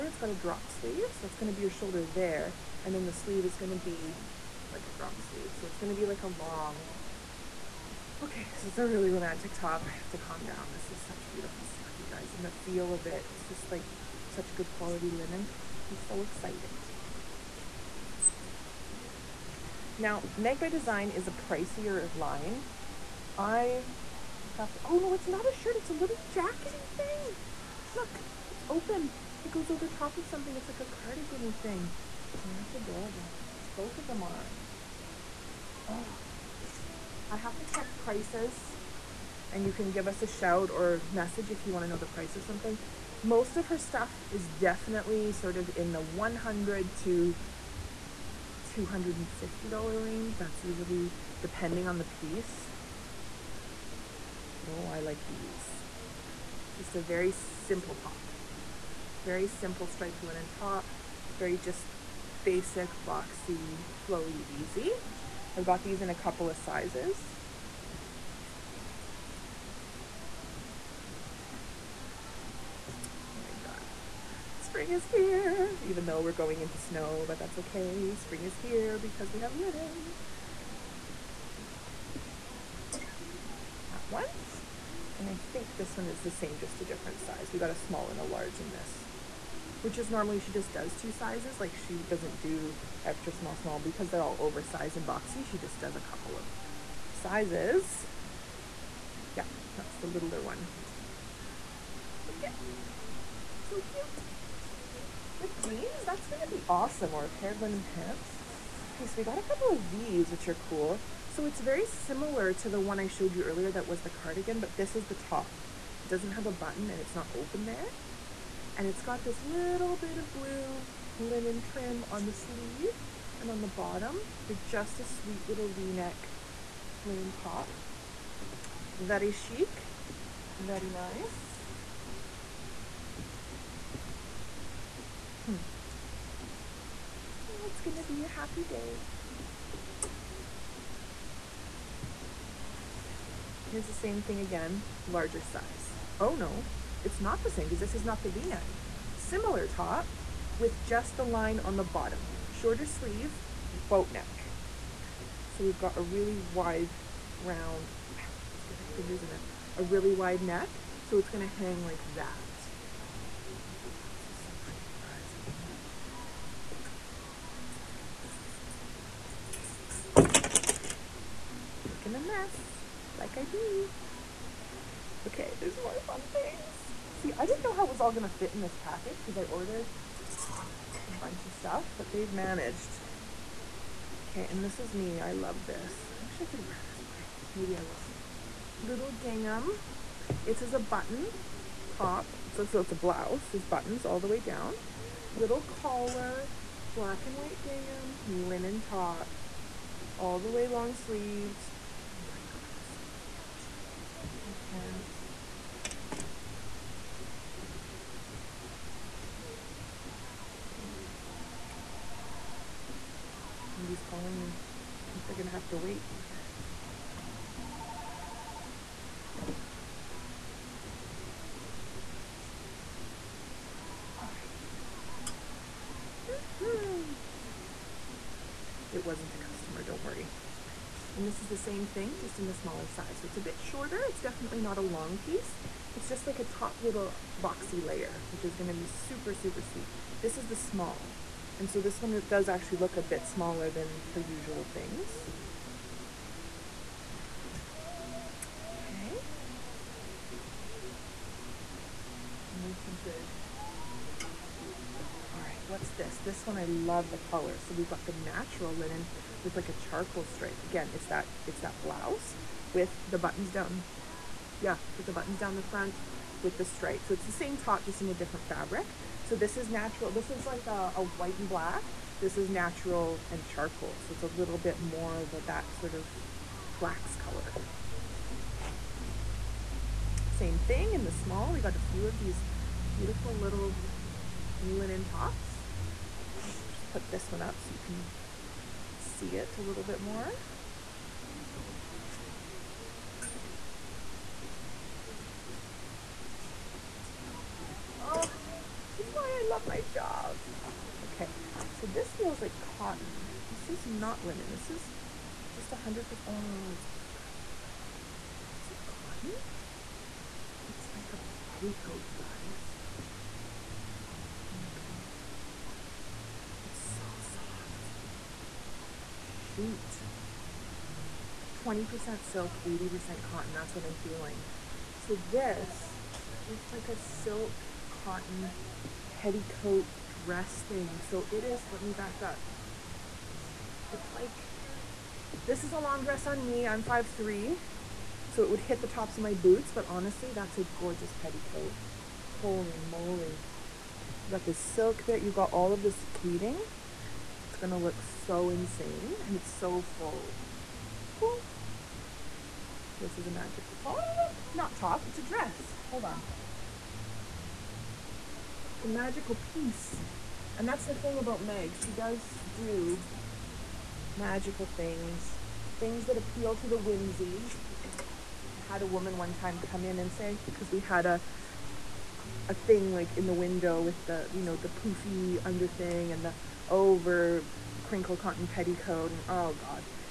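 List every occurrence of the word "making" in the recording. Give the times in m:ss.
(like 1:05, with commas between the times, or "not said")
2:51.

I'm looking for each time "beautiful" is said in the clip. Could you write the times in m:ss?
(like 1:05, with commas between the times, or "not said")
0:11, 4:42, 5:06.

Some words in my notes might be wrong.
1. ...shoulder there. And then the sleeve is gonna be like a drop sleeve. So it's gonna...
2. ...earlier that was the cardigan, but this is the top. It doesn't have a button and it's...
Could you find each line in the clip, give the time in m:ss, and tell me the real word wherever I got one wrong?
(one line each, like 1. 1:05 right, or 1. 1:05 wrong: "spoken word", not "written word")
1. 0:01 right
2. 1:53 right.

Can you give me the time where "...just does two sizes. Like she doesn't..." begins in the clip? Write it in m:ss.
1:30.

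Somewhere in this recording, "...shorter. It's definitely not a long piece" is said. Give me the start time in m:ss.
3:53.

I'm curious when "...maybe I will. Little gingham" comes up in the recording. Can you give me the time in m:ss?
3:07.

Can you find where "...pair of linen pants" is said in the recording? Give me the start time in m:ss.
1:47.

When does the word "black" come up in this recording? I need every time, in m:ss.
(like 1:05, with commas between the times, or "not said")
3:16, 4:31.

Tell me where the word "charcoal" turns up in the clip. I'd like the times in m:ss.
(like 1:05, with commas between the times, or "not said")
4:19, 4:33.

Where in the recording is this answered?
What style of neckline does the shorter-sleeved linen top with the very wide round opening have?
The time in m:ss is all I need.
2:33.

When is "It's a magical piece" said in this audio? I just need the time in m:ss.
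5:58.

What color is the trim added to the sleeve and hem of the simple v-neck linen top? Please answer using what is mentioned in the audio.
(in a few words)
Blue.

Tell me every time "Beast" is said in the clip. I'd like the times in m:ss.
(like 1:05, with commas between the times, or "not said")
not said.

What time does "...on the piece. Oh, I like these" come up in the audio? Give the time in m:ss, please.
0:51.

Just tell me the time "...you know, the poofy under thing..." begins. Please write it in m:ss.
6:14.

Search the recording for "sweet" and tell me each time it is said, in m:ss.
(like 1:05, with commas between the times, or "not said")
2:05, 3:59.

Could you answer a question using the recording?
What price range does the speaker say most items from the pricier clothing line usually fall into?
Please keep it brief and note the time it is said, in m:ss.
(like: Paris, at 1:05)
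$100 to $250, at 0:45.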